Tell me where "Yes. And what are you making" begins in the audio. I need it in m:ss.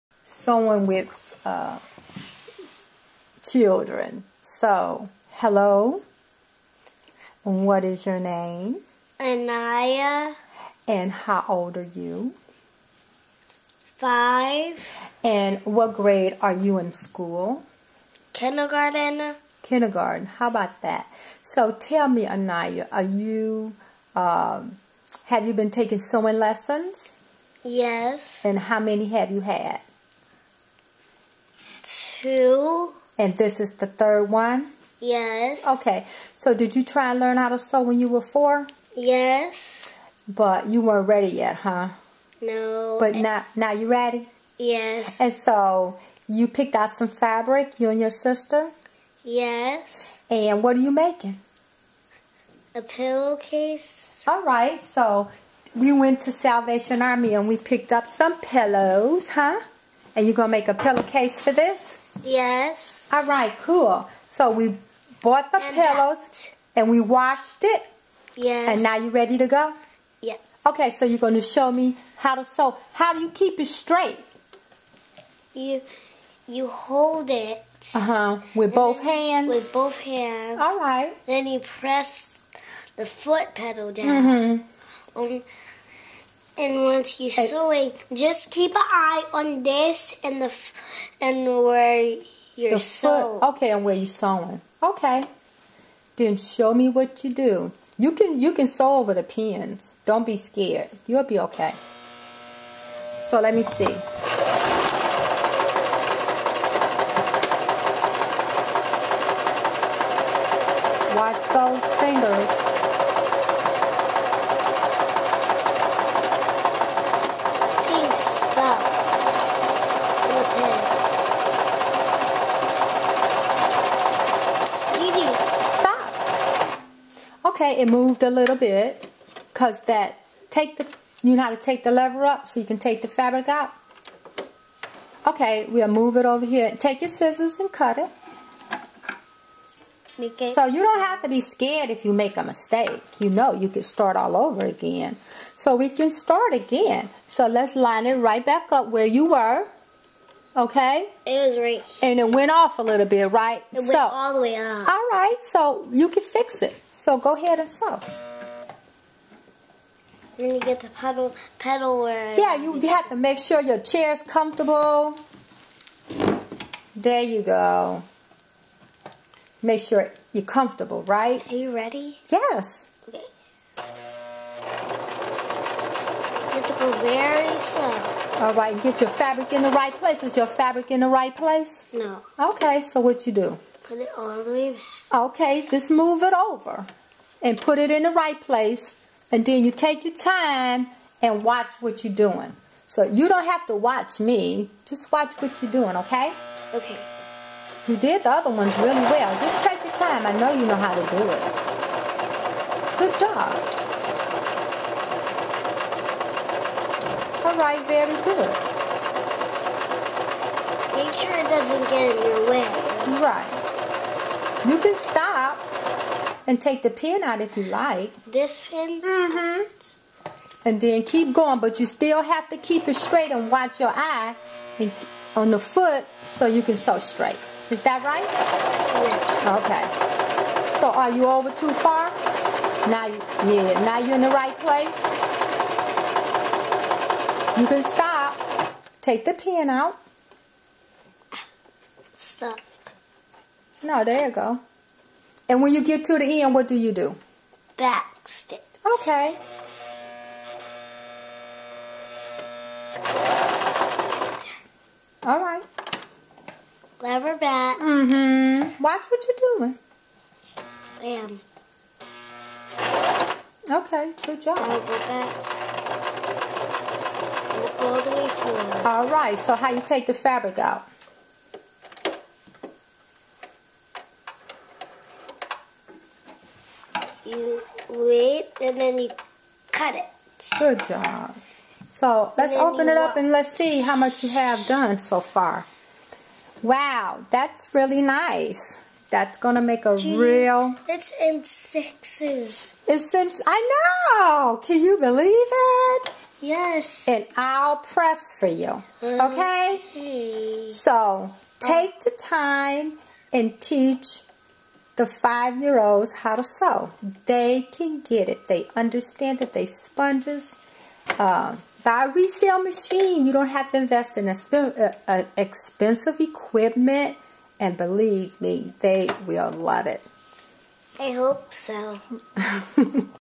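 0:49.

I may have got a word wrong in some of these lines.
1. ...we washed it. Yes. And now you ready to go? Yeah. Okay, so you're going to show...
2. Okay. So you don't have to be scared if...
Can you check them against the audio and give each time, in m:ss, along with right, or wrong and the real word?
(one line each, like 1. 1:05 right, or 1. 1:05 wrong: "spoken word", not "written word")
1. 1:06 right
2. 2:20 right.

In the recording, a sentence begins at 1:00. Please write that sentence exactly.
And you're going to make a pillowcase for this?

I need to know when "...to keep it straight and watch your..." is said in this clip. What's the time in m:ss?
3:42.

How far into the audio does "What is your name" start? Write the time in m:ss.
0:07.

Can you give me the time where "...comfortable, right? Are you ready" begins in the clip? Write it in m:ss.
2:50.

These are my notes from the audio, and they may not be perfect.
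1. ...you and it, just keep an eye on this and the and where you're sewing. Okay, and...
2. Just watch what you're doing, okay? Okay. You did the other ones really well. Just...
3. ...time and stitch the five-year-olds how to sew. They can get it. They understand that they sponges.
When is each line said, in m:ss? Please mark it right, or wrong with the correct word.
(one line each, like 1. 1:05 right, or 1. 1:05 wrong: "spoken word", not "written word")
1. 1:27 right
2. 3:14 right
3. 5:02 wrong: "teach", not "stitch".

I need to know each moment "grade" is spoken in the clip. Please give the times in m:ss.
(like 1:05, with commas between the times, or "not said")
0:15.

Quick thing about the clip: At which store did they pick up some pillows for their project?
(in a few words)
Salvation Army.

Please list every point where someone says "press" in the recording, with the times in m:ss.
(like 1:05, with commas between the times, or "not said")
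1:21, 4:57.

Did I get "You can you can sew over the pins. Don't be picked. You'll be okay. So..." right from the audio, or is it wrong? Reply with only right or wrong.
wrong.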